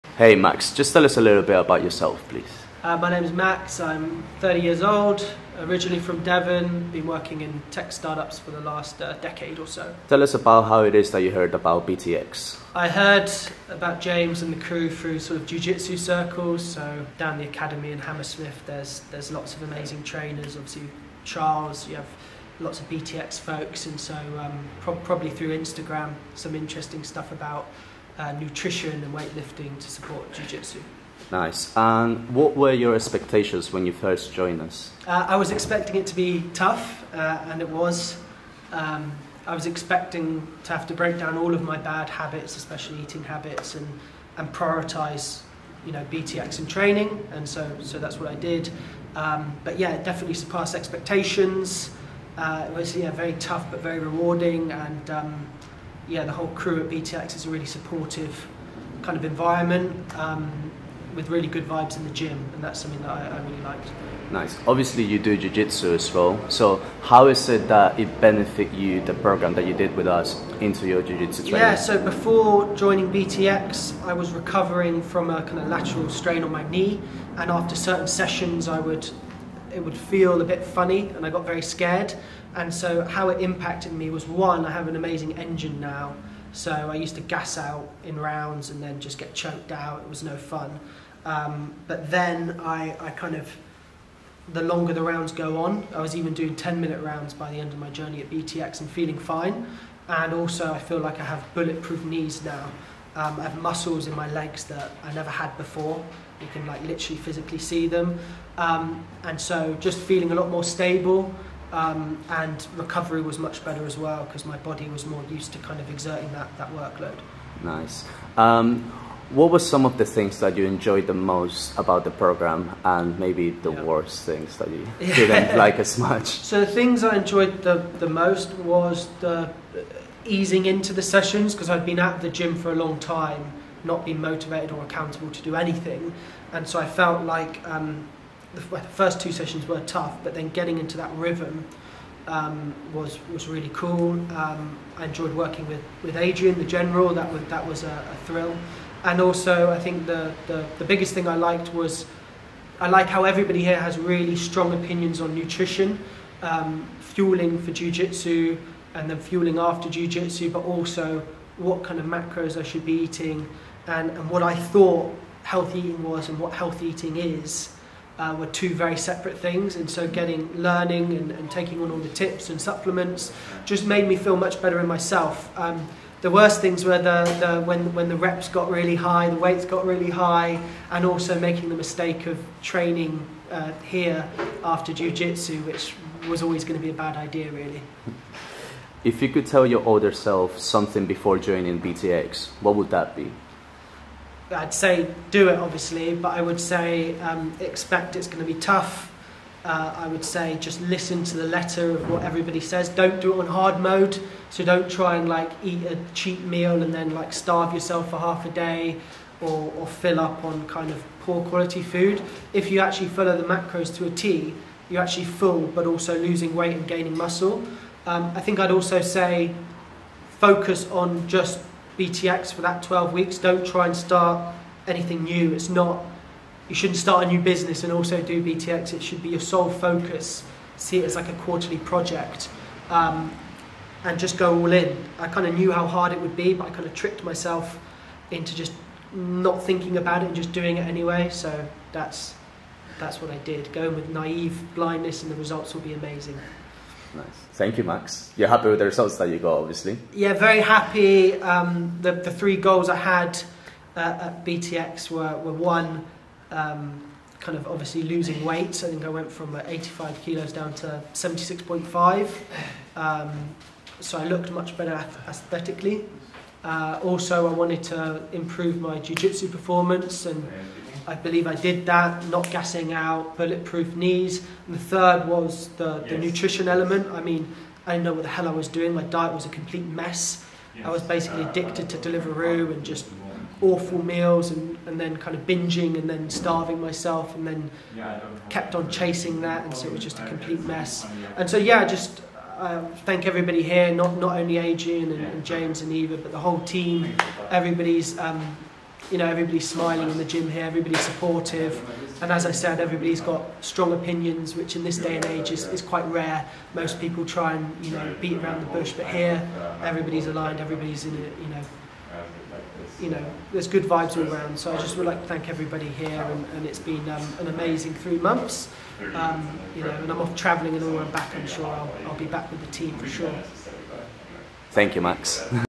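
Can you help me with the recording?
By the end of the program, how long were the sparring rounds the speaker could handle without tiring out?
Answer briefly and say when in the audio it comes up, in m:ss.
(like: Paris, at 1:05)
10 minutes, at 1:36.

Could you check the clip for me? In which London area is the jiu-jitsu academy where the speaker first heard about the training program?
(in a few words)
Hammersmith.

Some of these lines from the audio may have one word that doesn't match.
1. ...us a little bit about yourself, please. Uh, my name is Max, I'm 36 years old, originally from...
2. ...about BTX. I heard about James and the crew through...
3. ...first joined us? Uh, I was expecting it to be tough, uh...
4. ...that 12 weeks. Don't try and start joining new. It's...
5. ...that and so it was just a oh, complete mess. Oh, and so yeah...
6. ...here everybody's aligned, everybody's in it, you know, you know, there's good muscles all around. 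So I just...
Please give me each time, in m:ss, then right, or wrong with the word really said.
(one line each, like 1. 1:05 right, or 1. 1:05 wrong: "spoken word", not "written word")
1. 0:01 wrong: "30", not "36"
2. 0:11 right
3. 0:33 right
4. 3:42 wrong: "anything", not "joining"
5. 4:49 right
6. 5:09 wrong: "vibes", not "muscles".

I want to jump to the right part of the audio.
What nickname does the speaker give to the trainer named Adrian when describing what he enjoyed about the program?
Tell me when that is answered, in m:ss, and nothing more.
2:26.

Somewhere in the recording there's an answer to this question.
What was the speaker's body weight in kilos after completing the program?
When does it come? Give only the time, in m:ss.
4:21.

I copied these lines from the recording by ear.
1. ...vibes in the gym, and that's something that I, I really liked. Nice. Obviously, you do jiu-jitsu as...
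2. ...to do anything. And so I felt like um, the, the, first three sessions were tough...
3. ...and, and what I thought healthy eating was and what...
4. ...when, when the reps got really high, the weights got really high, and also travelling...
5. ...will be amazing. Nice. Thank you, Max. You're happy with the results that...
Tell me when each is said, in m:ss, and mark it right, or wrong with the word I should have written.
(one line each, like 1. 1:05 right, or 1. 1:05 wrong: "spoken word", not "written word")
1. 1:01 right
2. 2:15 wrong: "two", not "three"
3. 2:43 right
4. 2:57 wrong: "making", not "travelling"
5. 4:05 right.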